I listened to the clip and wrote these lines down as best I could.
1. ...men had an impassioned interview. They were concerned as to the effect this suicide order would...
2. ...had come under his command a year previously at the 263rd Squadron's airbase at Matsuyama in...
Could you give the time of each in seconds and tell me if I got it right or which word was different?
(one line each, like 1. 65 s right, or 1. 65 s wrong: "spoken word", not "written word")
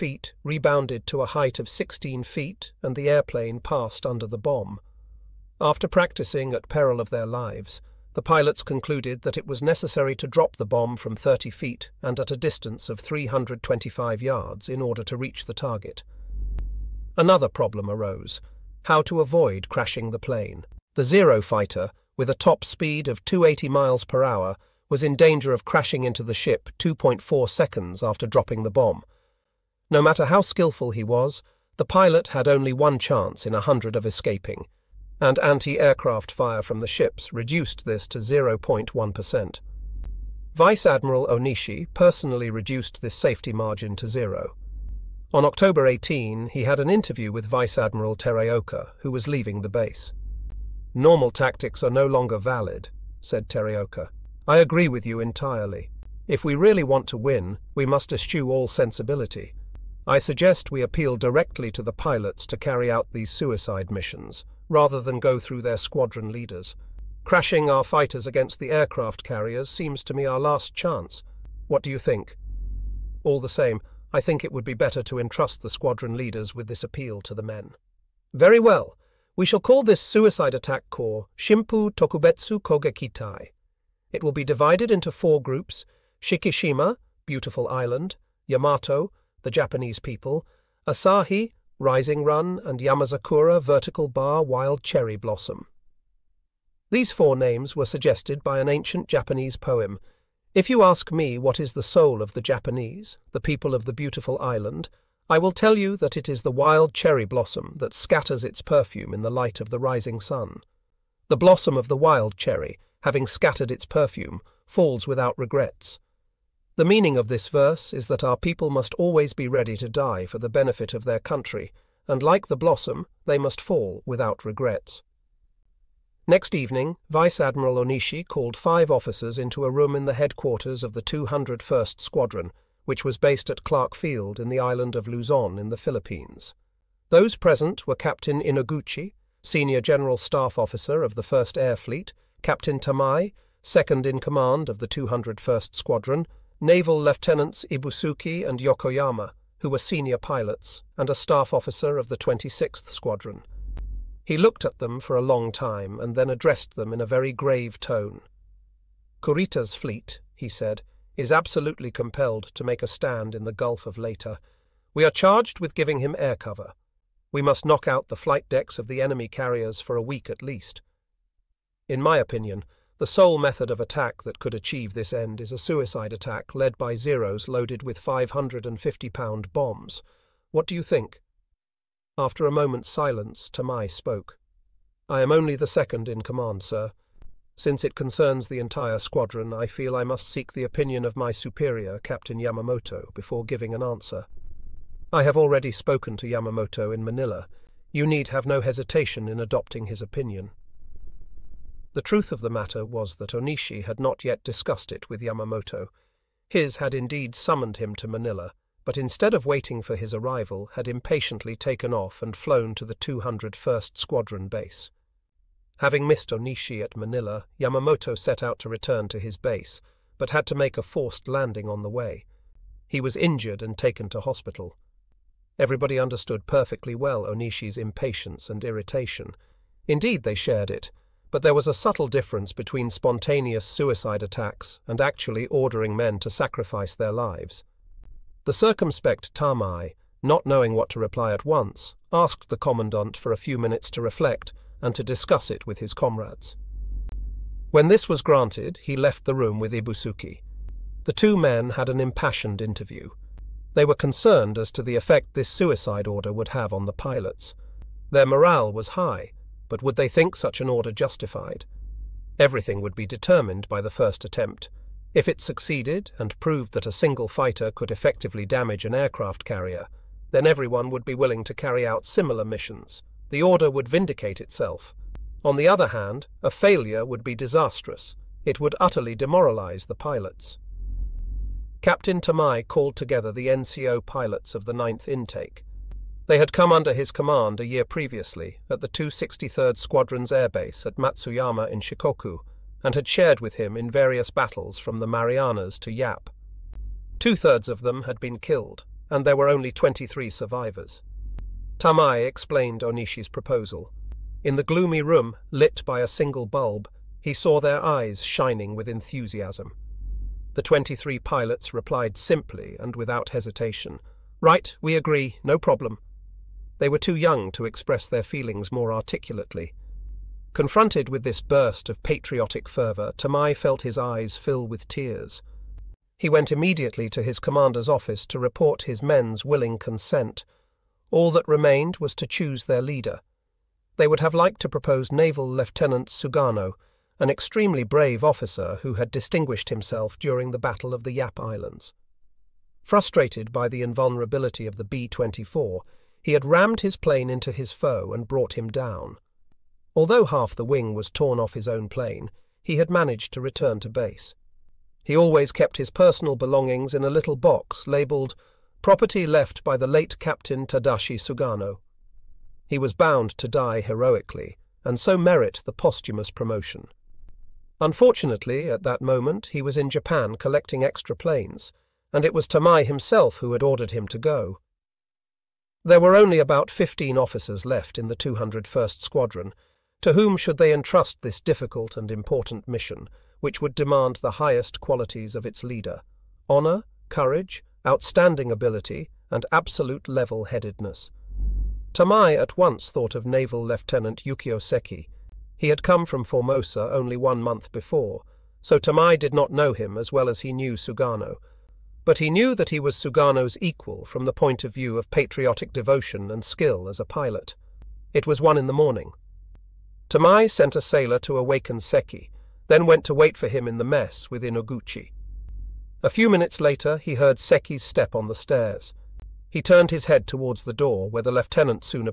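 1. 251 s right
2. 286 s right.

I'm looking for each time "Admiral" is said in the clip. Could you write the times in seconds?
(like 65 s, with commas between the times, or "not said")
40 s, 47 s, 127 s.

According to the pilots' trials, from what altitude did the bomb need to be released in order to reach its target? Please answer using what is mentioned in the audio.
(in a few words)
30 feet.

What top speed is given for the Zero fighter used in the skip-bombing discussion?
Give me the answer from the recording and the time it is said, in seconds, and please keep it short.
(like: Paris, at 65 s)
280 miles per hour, at 23 s.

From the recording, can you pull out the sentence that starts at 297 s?
Two thirds of them had been killed, and there were only 23 survivors.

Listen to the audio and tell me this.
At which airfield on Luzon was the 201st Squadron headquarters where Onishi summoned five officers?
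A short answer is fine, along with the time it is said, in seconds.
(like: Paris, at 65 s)
Clark Field, at 133 s.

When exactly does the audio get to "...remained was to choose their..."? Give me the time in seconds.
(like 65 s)
331 s.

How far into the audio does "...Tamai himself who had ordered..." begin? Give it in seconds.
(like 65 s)
372 s.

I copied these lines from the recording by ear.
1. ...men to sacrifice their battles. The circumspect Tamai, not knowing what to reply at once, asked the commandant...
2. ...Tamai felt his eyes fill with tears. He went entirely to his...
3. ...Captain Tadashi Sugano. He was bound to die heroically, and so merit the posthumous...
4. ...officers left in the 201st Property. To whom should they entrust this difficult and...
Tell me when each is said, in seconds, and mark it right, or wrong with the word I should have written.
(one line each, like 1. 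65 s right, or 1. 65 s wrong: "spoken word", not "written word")
1. 235 s wrong: "lives", not "battles"
2. 323 s wrong: "immediately", not "entirely"
3. 360 s right
4. 377 s wrong: "Squadron", not "Property".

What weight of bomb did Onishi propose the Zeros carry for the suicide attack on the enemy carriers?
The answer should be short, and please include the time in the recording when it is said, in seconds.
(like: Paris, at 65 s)
550 pound, at 177 s.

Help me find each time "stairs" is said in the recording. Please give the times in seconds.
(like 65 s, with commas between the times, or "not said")
418 s.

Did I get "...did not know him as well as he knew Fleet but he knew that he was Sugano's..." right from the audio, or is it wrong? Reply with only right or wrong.
wrong.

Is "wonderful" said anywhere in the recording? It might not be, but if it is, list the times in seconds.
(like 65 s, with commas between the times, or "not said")
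not said.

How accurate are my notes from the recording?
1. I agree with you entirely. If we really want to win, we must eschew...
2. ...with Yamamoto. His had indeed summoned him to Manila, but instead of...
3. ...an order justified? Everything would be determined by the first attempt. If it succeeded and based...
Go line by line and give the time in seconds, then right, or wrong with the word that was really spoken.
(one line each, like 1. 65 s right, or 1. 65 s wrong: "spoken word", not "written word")
1. 54 s right
2. 205 s right
3. 260 s wrong: "proved", not "based".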